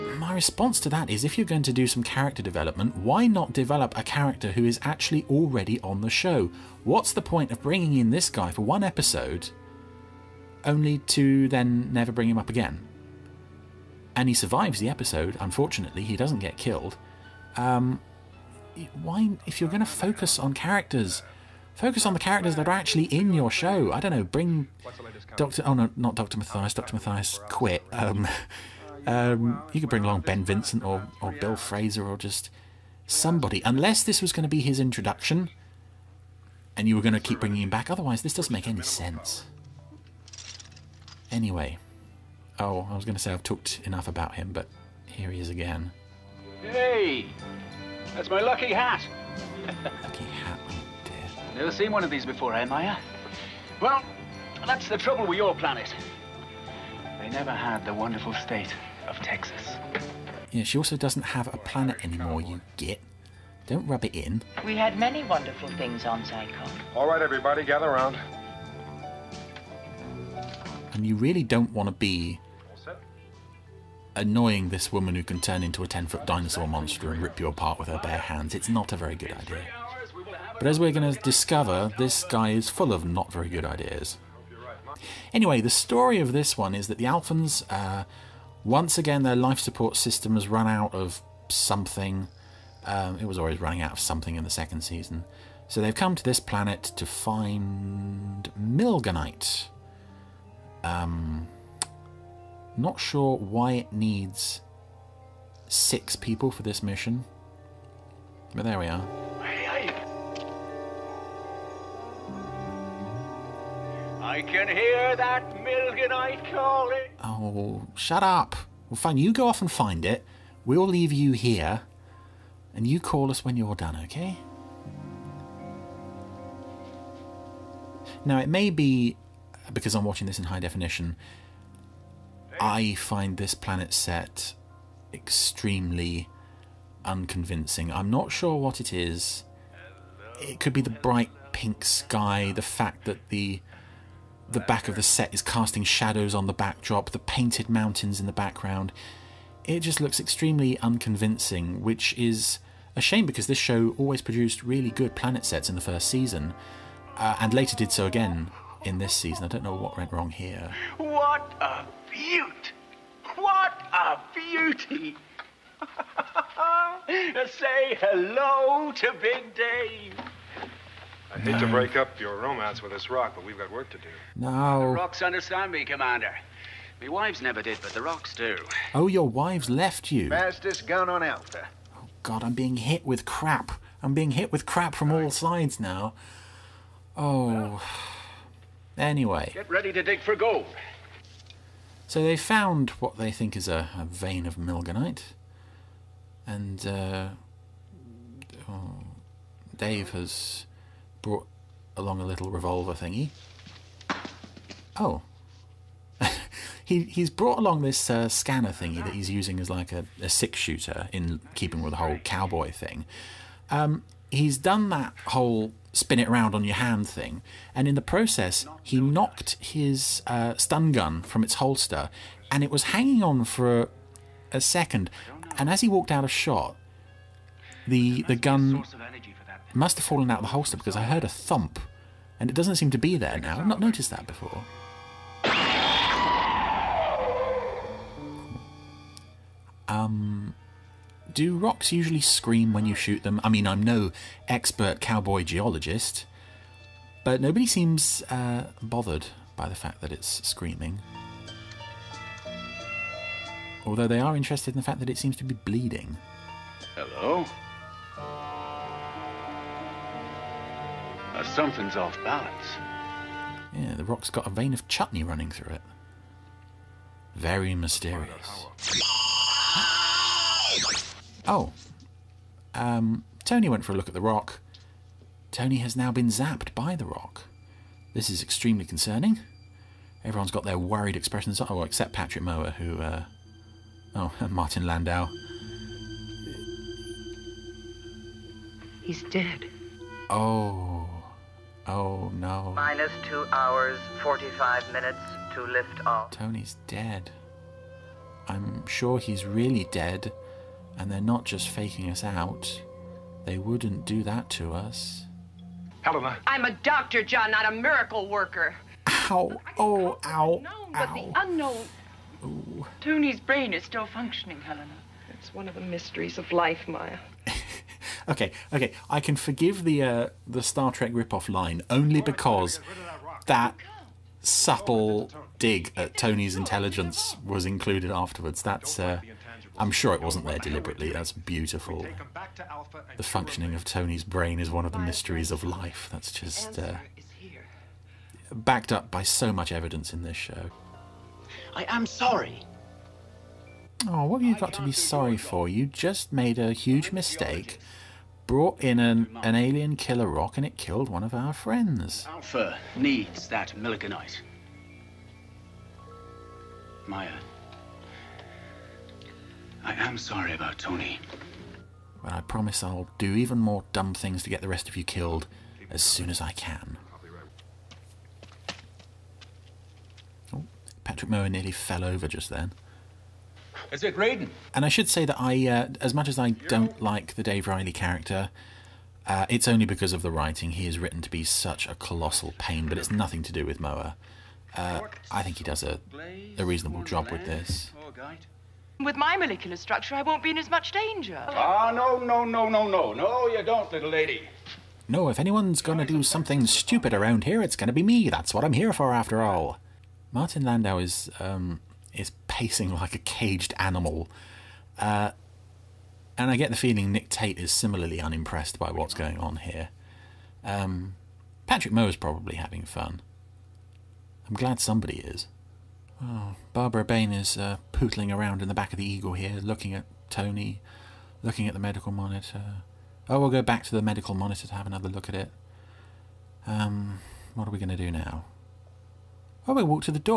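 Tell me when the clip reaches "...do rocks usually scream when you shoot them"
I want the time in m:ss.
4:01.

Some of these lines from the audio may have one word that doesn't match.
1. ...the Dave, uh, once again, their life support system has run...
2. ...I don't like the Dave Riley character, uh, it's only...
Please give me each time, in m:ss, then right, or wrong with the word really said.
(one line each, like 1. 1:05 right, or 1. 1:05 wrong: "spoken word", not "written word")
1. 1:26 wrong: "Alphans", not "Dave"
2. 6:16 right.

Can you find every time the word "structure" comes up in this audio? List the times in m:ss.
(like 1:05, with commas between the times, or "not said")
6:29.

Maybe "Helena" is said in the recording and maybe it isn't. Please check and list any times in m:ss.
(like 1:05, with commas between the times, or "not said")
5:06, 5:14.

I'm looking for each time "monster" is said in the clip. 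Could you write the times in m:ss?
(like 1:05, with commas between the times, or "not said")
1:16.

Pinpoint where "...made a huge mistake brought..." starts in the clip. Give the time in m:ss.
5:46.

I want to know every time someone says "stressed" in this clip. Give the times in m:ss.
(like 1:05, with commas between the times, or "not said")
not said.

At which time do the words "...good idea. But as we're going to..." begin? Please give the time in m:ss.
1:19.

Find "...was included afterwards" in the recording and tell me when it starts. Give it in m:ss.
5:27.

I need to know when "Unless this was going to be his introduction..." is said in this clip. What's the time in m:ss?
0:33.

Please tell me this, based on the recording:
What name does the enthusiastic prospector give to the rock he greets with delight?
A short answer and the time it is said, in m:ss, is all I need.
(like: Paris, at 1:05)
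Big Dave, at 2:49.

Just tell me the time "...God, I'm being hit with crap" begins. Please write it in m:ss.
3:02.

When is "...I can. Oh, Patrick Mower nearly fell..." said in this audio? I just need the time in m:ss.
6:06.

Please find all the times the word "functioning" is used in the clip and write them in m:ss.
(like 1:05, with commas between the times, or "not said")
5:14, 5:33.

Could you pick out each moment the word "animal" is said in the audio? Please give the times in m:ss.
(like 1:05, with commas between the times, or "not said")
6:43.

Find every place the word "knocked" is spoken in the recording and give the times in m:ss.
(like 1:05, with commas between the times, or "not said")
3:39.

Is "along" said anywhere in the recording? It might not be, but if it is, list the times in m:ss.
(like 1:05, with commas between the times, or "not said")
0:30, 3:21, 3:27.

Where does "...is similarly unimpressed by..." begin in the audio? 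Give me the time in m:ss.
6:47.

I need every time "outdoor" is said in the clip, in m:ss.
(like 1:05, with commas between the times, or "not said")
not said.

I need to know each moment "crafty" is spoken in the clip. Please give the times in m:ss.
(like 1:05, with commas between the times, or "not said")
not said.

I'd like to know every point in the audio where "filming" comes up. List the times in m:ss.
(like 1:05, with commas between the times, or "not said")
not said.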